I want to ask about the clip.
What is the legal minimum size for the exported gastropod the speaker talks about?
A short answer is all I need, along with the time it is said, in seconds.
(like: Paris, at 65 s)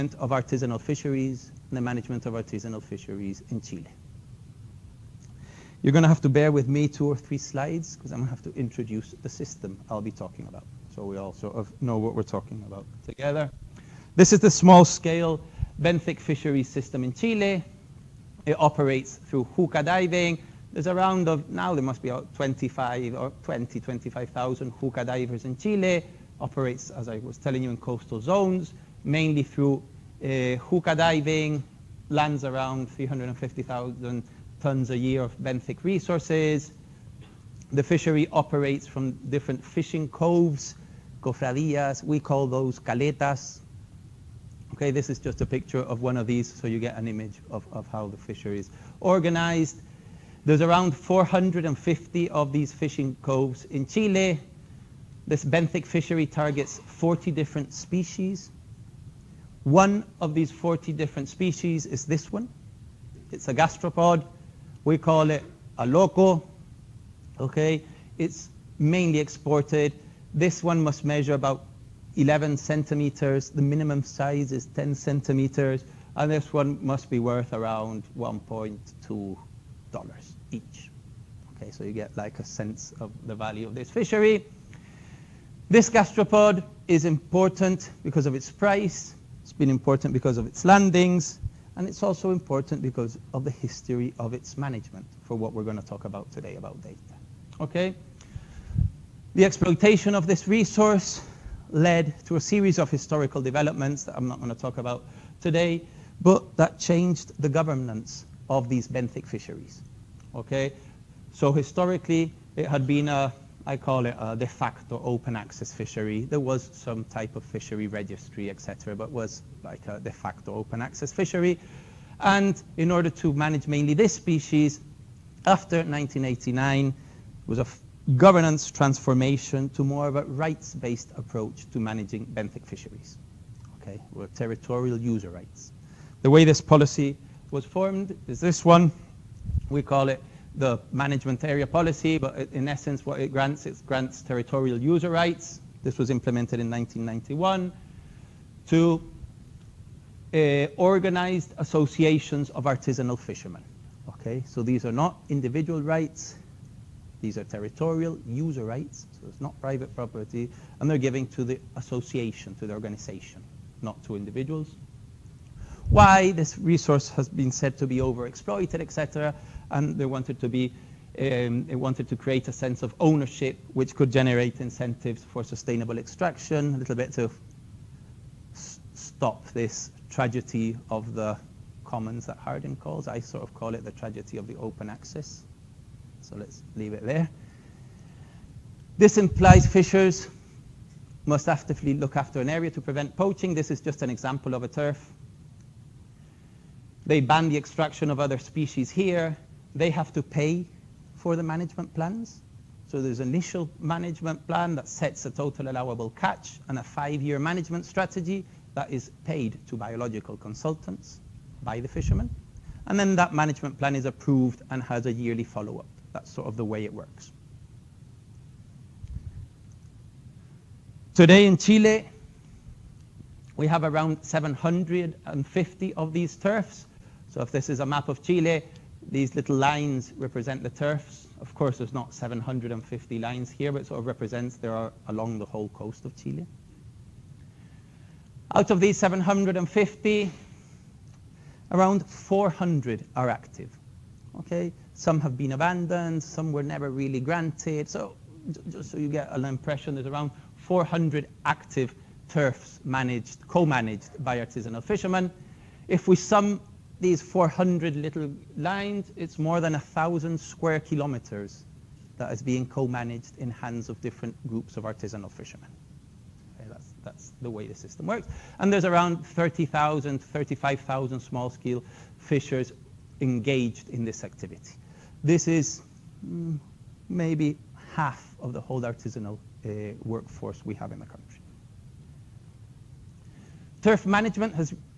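10 centimeters, at 74 s.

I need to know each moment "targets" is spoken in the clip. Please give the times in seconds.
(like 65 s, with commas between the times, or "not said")
56 s.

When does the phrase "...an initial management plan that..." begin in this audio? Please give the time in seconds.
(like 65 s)
203 s.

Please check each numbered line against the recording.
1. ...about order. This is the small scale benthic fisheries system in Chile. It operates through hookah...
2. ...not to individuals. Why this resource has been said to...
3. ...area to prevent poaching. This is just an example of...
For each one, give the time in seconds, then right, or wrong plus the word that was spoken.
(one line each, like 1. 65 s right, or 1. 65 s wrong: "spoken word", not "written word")
1. 12 s wrong: "together", not "order"
2. 163 s right
3. 192 s right.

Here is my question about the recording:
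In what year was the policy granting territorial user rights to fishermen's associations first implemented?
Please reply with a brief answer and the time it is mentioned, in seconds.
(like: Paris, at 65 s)
1991, at 146 s.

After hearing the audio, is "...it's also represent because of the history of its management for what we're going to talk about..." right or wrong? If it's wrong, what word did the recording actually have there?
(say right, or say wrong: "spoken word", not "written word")
wrong: "important", not "represent".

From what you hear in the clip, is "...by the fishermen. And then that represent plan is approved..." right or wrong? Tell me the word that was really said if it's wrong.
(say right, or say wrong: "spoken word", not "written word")
wrong: "management", not "represent".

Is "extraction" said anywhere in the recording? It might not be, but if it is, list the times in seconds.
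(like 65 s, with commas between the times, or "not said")
175 s, 197 s.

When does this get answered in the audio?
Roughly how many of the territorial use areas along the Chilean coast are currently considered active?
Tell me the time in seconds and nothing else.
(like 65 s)
241 s.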